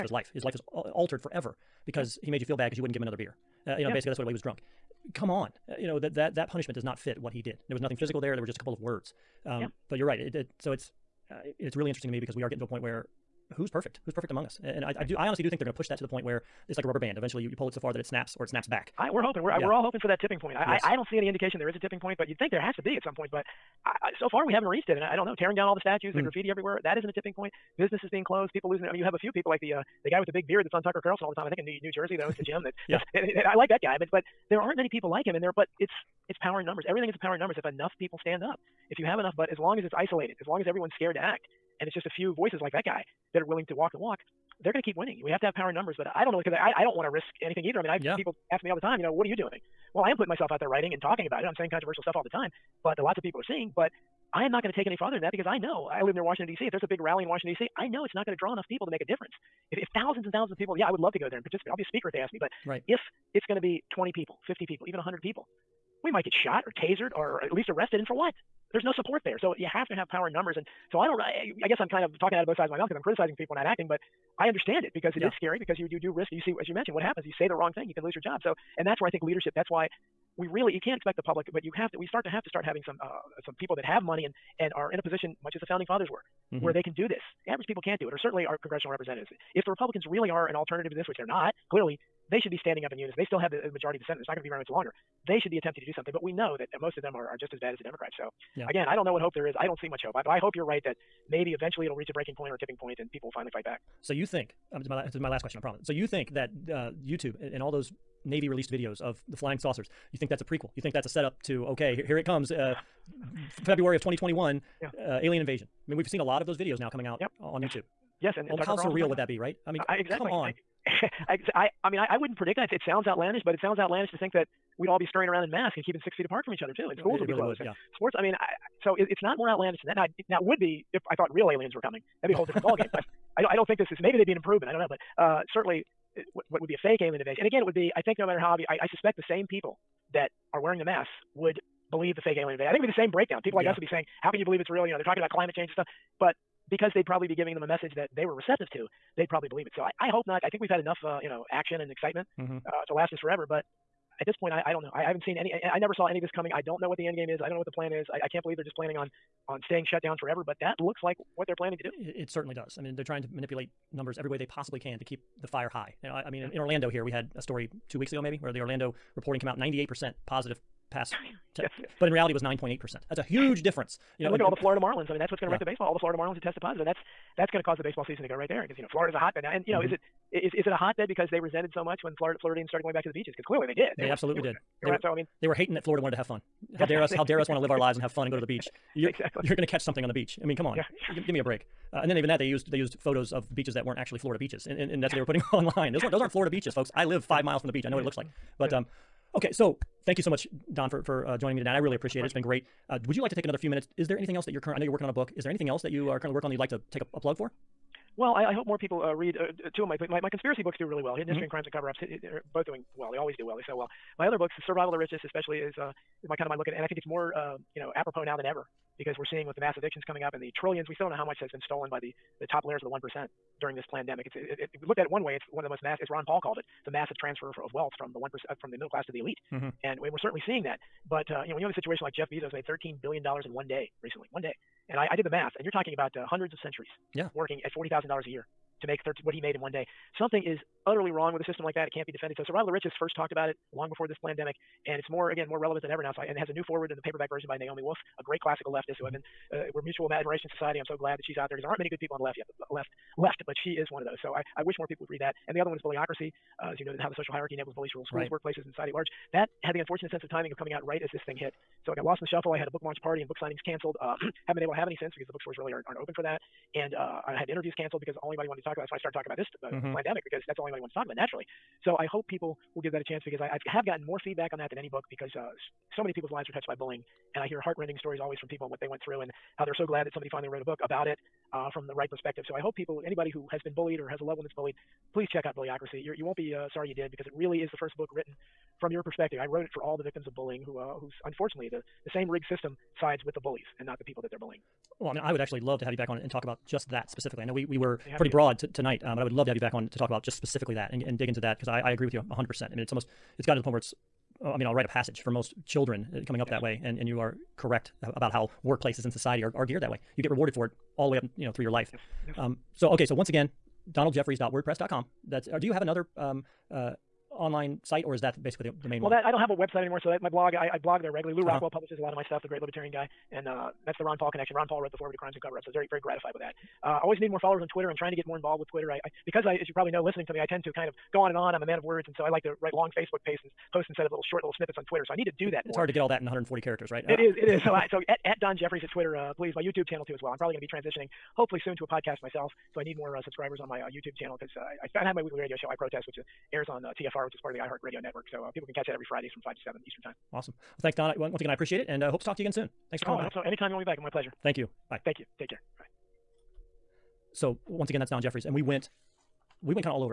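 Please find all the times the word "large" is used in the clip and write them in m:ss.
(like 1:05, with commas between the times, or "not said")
4:18.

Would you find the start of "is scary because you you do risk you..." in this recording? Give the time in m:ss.
1:15.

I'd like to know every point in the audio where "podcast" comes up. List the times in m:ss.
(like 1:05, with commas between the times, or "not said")
5:41.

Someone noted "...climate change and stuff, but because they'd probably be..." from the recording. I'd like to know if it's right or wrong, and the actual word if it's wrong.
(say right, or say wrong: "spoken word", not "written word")
right.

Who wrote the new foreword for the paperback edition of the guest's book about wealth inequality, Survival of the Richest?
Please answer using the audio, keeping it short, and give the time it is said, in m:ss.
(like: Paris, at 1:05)
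Naomi Wolf, at 4:07.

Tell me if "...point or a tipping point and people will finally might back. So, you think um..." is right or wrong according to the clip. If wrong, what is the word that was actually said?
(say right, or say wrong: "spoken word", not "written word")
wrong: "fight", not "might".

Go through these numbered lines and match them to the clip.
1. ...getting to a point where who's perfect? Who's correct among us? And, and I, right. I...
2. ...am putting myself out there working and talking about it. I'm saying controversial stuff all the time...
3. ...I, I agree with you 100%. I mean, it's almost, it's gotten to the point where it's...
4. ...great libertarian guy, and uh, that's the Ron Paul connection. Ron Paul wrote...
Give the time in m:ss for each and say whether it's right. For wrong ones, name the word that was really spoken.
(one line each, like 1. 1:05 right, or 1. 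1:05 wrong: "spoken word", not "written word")
1. 0:12 wrong: "perfect", not "correct"
2. 0:50 wrong: "writing", not "working"
3. 5:01 right
4. 5:22 right.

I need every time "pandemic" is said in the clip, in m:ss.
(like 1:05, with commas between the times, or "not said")
3:43, 4:04, 4:29.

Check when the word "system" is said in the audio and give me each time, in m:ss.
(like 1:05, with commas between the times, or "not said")
4:01, 4:52.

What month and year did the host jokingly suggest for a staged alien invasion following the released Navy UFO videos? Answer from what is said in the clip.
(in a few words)
February 2021.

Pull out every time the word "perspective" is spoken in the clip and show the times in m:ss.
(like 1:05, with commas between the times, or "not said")
4:42, 4:49.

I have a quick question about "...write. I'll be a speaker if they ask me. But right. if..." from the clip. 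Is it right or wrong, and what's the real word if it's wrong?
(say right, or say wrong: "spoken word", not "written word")
wrong: "participate", not "write".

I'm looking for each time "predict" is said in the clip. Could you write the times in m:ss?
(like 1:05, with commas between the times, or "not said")
2:02.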